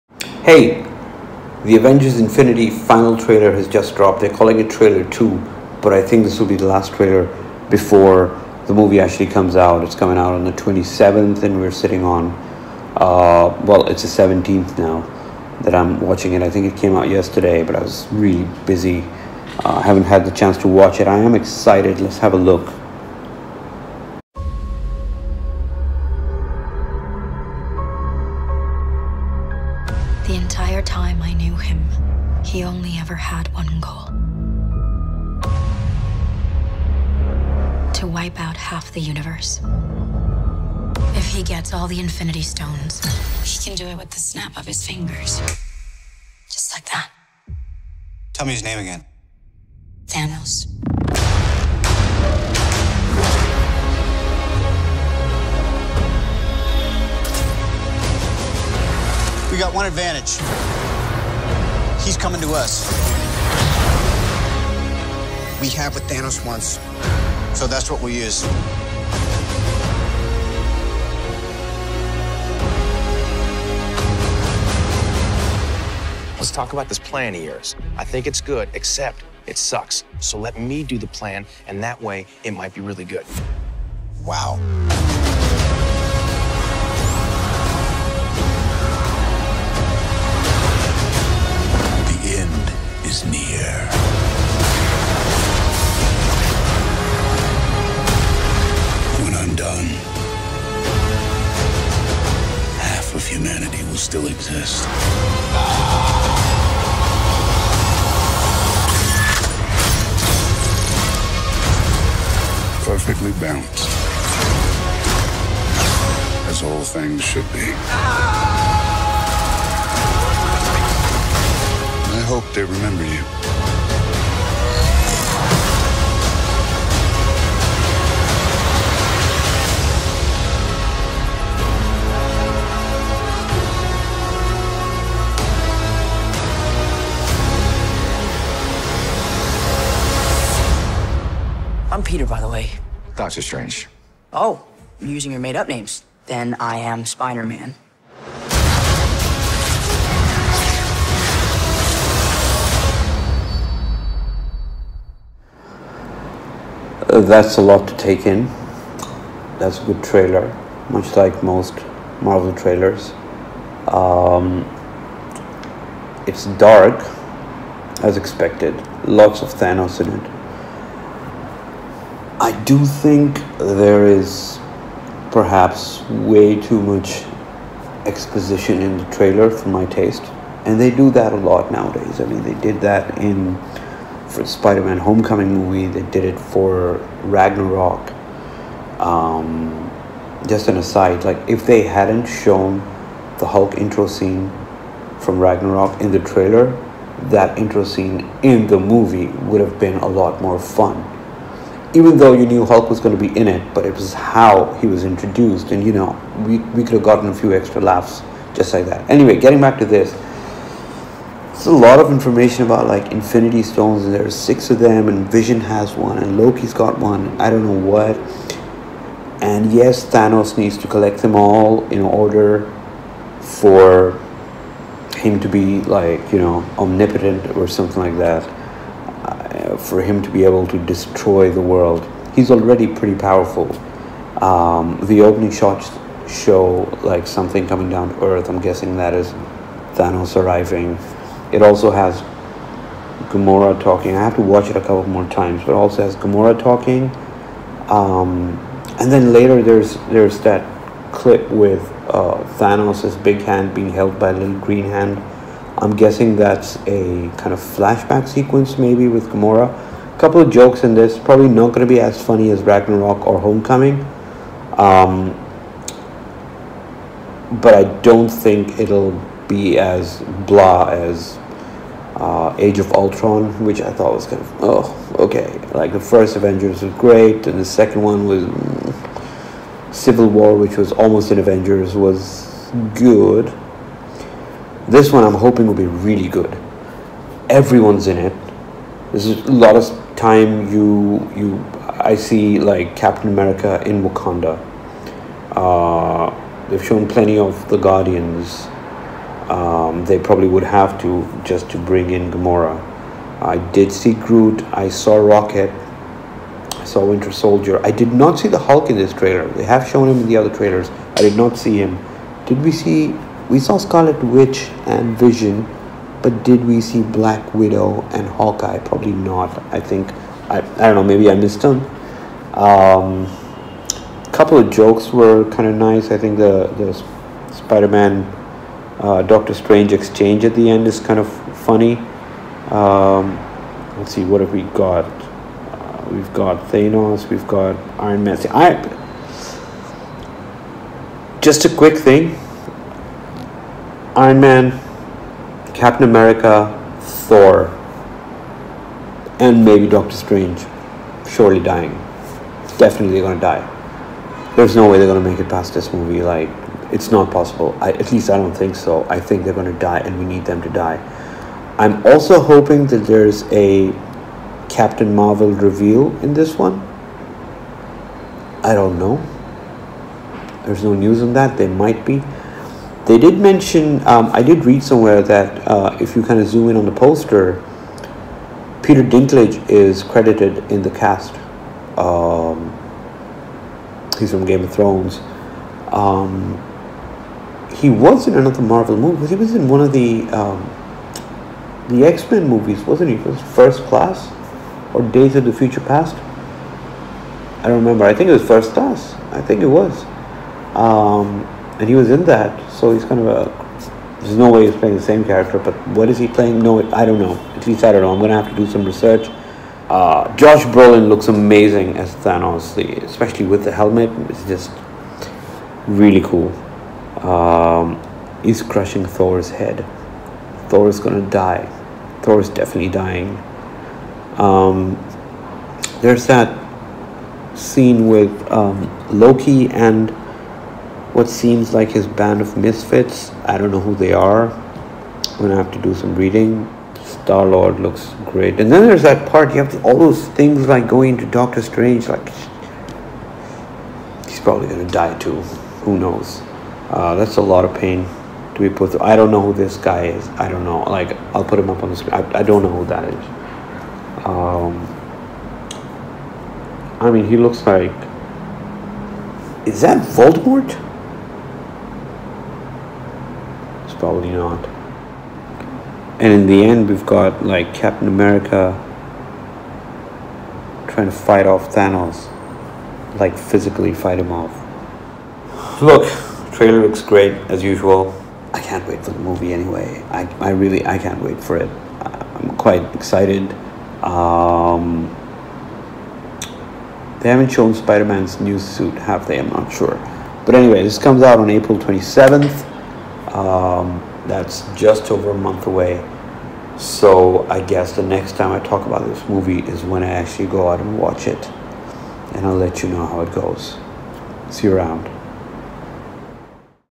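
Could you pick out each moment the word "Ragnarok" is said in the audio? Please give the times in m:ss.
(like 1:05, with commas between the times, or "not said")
3:07, 3:15, 4:22.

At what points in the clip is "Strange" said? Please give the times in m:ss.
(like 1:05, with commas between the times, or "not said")
2:23, 5:29, 5:50, 7:21.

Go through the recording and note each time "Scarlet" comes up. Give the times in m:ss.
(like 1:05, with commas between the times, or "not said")
5:13.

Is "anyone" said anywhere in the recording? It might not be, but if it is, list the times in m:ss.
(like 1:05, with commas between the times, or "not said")
not said.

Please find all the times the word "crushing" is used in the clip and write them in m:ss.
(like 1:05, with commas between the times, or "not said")
6:58.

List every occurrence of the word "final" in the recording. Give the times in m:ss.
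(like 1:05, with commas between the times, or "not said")
0:02.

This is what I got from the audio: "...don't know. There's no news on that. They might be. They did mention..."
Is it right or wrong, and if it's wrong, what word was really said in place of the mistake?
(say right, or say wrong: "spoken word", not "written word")
right.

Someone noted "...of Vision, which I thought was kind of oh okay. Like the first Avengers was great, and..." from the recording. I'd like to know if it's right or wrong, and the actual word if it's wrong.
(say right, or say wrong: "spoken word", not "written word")
wrong: "Ultron", not "Vision".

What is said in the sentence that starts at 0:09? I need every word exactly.
It's coming out on the 27th, and we're sitting on, uh, well, it's the 17th now that I'm watching it.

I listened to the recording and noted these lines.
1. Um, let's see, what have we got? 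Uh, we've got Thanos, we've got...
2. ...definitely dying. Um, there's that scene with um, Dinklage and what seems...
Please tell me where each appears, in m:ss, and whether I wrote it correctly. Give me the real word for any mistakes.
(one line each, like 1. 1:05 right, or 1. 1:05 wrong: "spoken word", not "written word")
1. 5:32 right
2. 7:02 wrong: "Loki", not "Dinklage".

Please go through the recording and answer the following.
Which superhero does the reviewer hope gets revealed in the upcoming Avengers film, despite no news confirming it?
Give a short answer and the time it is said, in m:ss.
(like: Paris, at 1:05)
Captain Marvel, at 6:04.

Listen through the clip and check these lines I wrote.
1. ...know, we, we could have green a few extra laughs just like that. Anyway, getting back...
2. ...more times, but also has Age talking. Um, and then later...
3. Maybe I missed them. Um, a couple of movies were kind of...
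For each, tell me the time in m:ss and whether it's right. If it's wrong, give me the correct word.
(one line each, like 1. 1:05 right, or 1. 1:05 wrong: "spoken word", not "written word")
1. 3:25 wrong: "gotten", not "green"
2. 4:05 wrong: "Gamora", not "Age"
3. 5:21 wrong: "jokes", not "movies".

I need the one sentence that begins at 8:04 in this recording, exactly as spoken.
Um, they haven't shown Spider-Man's new suit, have they?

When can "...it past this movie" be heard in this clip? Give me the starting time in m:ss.
5:55.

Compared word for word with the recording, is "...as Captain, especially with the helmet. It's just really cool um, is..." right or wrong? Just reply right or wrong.
wrong.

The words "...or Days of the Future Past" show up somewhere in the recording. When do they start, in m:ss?
6:34.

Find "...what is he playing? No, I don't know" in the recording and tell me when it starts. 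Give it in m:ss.
6:45.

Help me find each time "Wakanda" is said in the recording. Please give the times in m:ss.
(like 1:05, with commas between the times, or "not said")
4:54.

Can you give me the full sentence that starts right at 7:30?
Like, I'll put him up on the screen.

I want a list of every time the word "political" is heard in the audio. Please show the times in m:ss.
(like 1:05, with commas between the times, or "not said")
not said.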